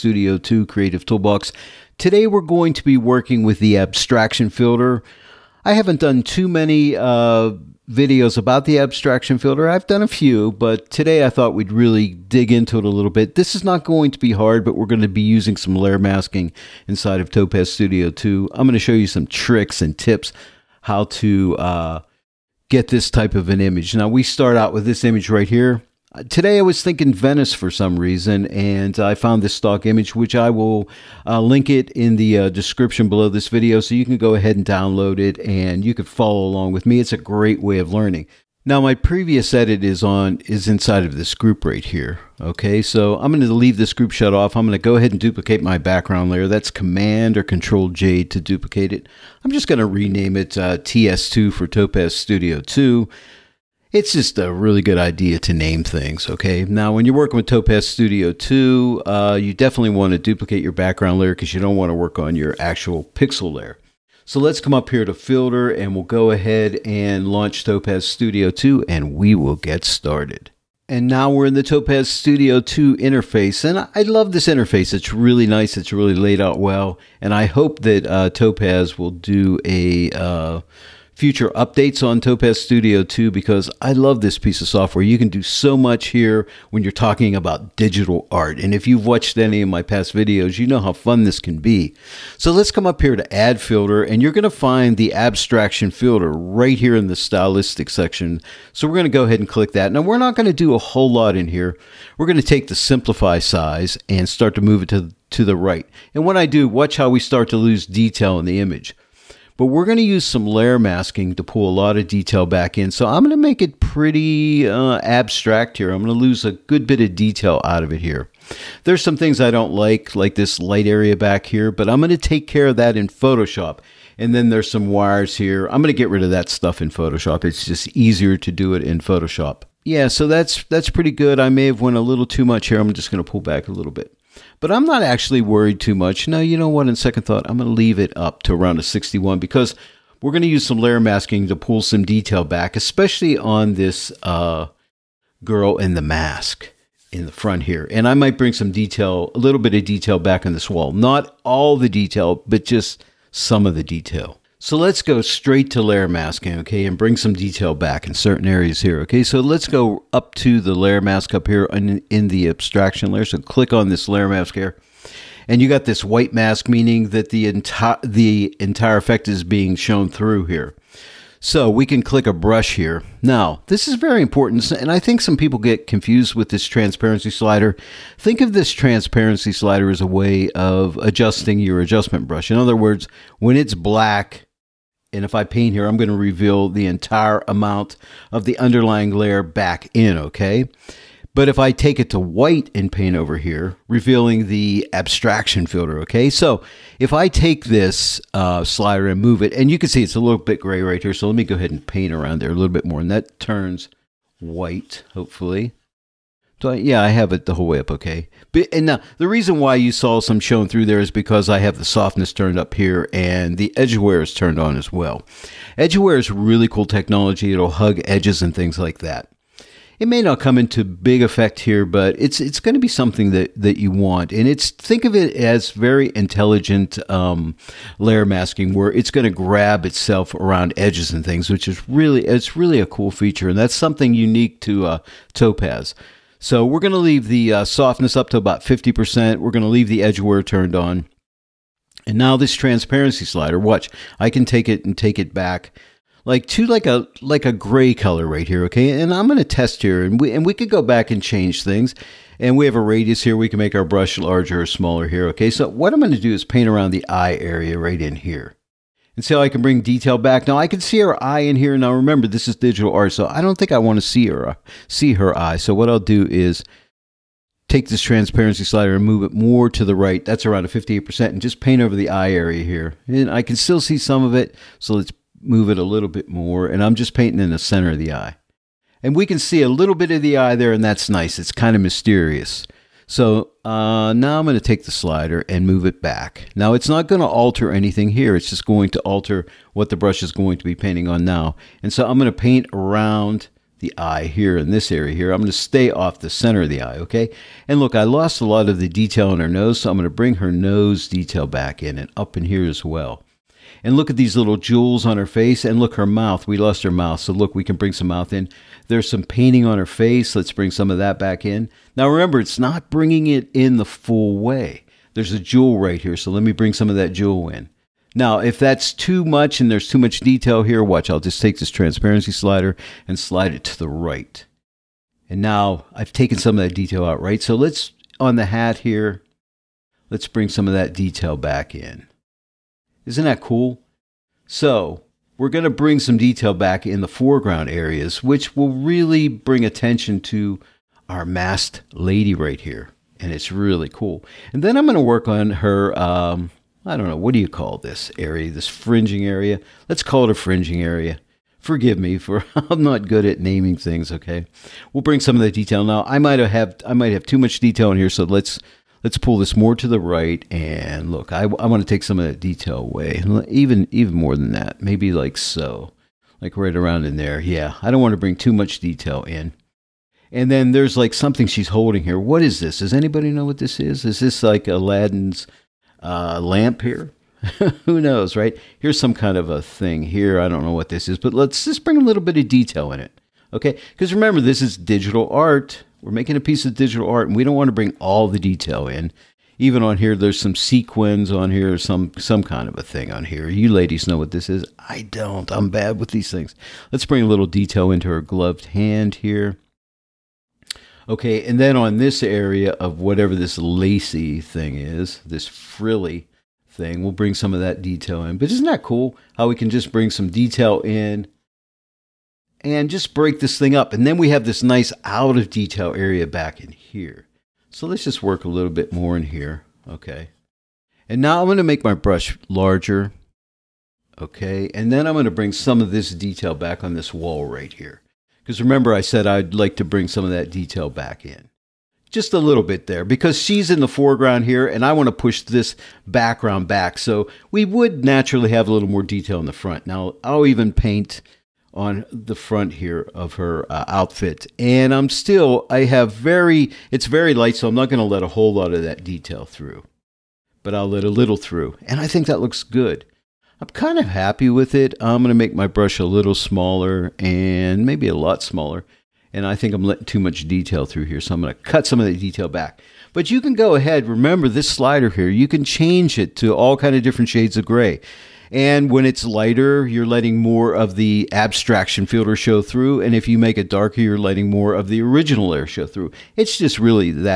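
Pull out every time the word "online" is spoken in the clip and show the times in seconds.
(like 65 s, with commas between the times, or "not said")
not said.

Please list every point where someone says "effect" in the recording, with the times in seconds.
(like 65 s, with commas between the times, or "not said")
168 s, 221 s.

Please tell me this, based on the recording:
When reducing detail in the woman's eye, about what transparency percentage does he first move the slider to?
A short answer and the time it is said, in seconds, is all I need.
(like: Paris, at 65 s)
58%, at 270 s.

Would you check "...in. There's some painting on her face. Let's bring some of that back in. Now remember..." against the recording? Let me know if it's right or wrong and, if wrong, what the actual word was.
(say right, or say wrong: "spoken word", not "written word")
right.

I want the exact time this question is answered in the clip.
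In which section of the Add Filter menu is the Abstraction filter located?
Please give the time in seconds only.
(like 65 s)
97 s.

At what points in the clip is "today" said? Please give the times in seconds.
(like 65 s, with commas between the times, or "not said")
1 s, 10 s, 26 s.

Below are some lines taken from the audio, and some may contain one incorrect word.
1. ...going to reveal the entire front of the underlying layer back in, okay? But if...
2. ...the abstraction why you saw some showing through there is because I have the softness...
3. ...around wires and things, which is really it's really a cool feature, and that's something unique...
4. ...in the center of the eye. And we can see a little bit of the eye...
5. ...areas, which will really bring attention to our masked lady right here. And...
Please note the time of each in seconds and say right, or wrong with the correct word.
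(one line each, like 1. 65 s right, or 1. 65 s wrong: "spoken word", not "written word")
1. 185 s wrong: "amount", not "front"
2. 209 s wrong: "reason", not "abstraction"
3. 230 s wrong: "edges", not "wires"
4. 277 s right
5. 337 s right.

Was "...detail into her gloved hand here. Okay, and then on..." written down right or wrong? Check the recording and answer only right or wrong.
right.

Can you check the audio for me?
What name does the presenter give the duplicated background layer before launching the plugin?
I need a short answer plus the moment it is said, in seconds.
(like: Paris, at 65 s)
TS2, at 50 s.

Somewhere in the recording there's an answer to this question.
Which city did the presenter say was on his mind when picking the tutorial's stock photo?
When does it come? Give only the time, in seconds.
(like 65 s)
27 s.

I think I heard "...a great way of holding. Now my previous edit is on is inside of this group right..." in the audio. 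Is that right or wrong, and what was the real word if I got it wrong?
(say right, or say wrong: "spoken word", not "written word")
wrong: "learning", not "holding".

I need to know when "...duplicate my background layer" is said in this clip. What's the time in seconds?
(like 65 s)
45 s.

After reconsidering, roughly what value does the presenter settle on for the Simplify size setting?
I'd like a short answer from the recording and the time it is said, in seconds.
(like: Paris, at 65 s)
61, at 138 s.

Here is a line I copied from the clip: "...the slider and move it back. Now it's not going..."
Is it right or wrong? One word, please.
right.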